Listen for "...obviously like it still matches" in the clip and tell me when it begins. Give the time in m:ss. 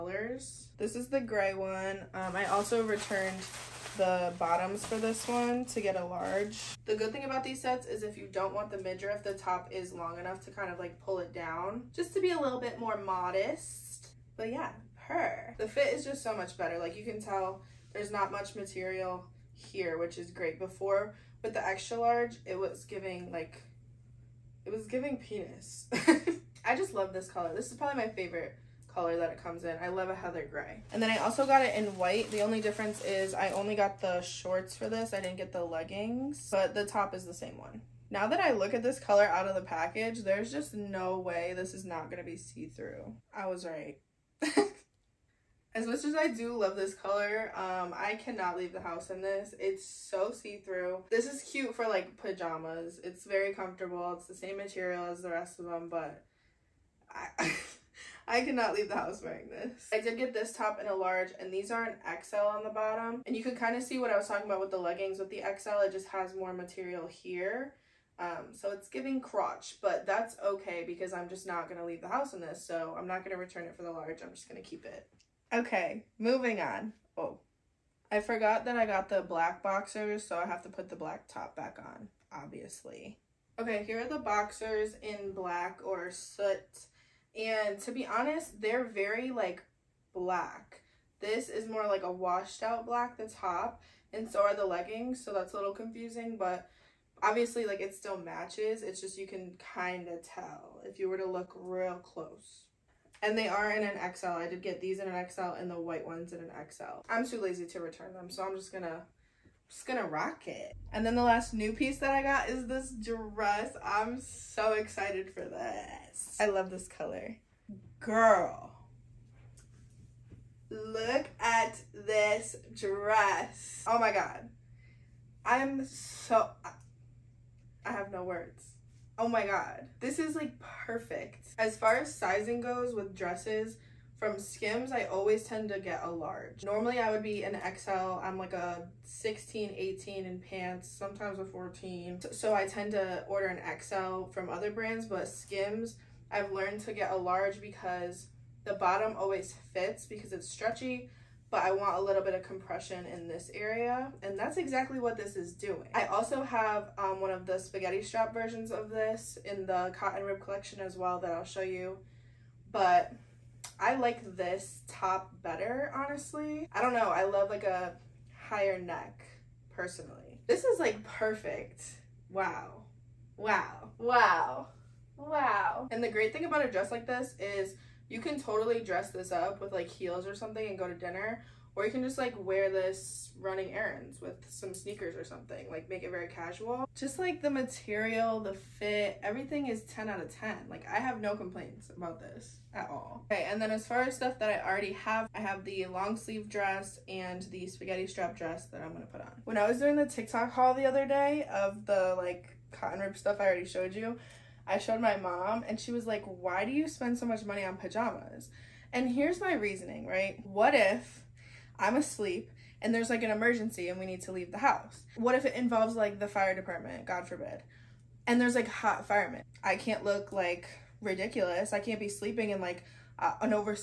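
1:37.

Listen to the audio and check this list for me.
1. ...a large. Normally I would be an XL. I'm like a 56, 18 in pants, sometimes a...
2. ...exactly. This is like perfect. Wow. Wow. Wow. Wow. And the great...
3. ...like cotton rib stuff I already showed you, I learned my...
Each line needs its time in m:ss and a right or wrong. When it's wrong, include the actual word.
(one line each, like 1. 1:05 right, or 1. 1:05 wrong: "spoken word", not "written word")
1. 2:16 wrong: "16", not "56"
2. 2:49 wrong: "personally", not "exactly"
3. 3:22 wrong: "showed", not "learned".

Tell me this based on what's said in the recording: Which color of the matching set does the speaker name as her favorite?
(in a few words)
Heather gray.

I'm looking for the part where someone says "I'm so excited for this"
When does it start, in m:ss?
1:53.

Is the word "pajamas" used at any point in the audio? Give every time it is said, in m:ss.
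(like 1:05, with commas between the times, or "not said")
0:52, 3:27.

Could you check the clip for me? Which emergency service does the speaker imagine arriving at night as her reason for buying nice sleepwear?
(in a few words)
Fire department.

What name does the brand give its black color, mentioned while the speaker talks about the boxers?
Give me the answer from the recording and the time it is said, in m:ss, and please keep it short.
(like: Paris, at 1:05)
Soot, at 1:26.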